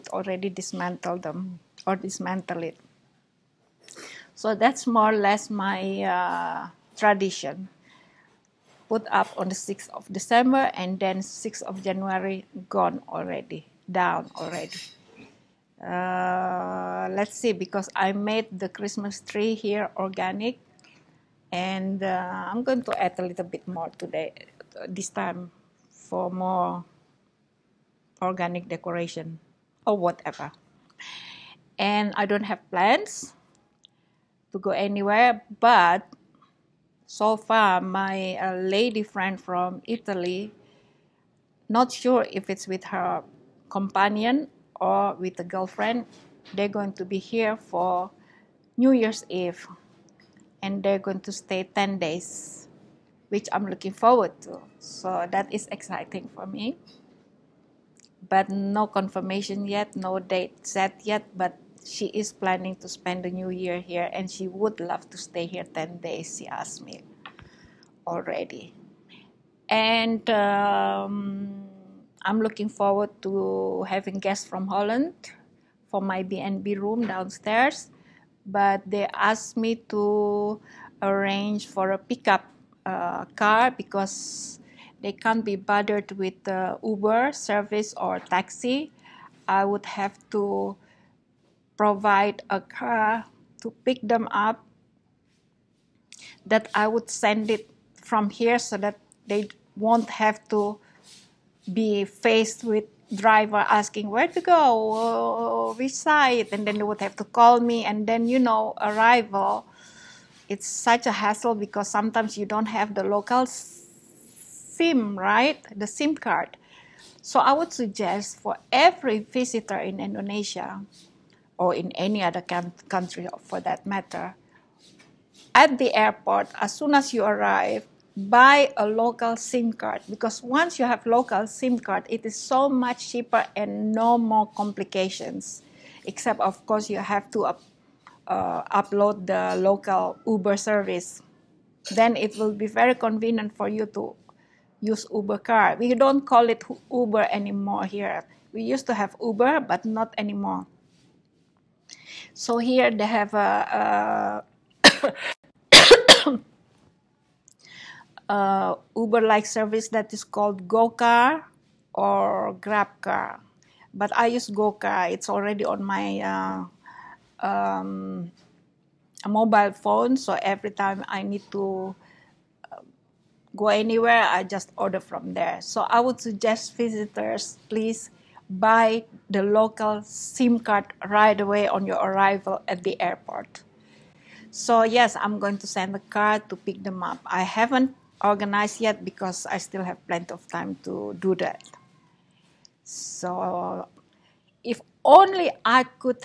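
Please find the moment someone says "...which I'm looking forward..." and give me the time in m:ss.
0:53.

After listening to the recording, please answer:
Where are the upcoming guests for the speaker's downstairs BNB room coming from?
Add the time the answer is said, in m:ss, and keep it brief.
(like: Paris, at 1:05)
Holland, at 1:14.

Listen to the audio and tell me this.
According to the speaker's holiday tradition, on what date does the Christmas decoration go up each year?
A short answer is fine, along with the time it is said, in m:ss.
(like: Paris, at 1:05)
6th of December, at 0:09.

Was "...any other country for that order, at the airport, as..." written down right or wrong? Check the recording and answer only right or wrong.
wrong.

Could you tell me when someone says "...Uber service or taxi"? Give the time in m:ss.
1:26.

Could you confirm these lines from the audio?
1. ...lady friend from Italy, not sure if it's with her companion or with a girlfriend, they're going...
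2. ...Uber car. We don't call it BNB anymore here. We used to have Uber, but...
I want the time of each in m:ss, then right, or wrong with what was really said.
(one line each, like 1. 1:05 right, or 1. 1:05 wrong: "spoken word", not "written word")
1. 0:38 right
2. 2:25 wrong: "Uber", not "BNB".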